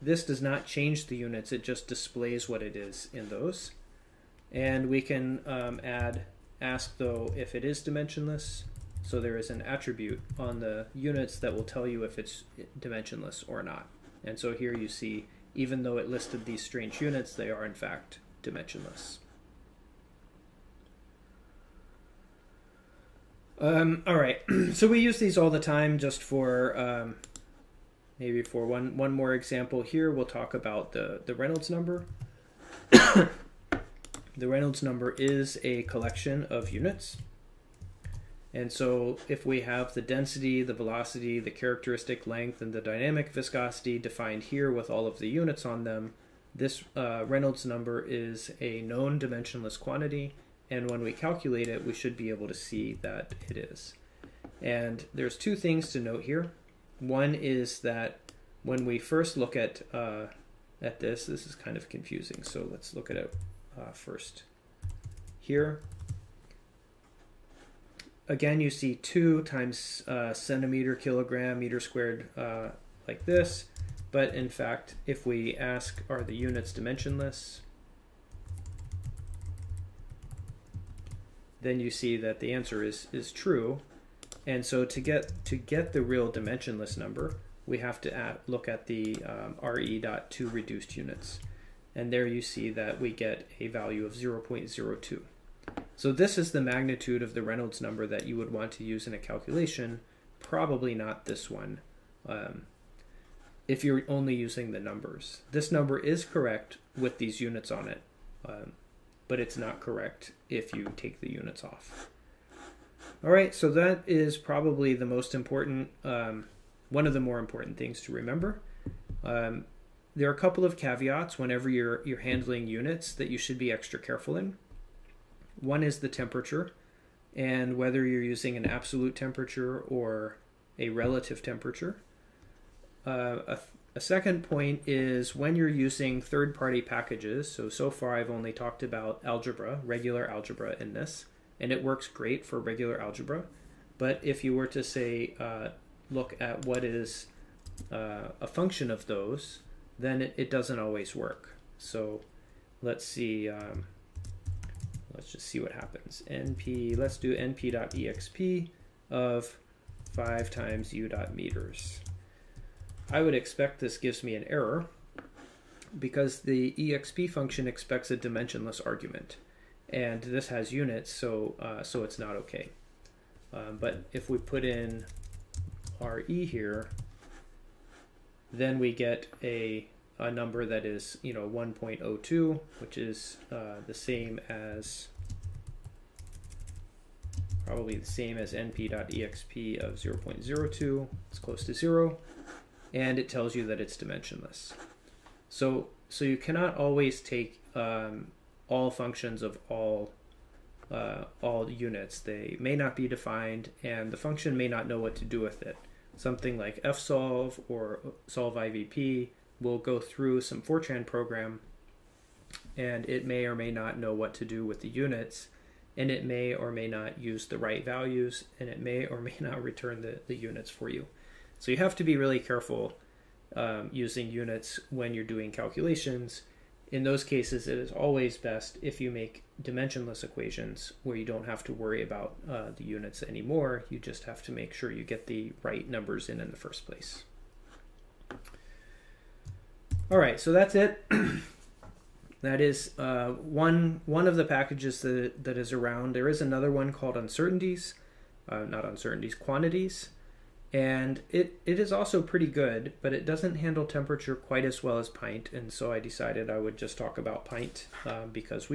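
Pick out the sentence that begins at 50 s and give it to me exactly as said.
And when we calculate it, we should be able to see that it is.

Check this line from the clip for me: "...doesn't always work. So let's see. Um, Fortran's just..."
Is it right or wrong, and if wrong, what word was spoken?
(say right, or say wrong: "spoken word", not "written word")
wrong: "Let", not "Fortran".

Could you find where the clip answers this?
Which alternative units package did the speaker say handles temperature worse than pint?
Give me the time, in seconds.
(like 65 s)
249 s.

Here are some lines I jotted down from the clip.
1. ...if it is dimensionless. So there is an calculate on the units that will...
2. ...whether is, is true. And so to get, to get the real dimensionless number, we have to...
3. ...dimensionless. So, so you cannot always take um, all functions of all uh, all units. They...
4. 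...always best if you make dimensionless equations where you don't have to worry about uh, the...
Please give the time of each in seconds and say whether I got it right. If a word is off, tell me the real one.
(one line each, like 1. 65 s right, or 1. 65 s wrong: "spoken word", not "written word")
1. 7 s wrong: "attribute", not "calculate"
2. 82 s wrong: "answer", not "whether"
3. 193 s right
4. 227 s right.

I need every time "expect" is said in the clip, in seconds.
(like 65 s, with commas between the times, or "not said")
163 s, 167 s.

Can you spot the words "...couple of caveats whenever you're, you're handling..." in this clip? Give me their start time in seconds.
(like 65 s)
120 s.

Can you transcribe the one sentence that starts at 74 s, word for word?
But in fact, if we ask, are the units dimensionless?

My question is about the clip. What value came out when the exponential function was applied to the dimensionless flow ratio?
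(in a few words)
1.02.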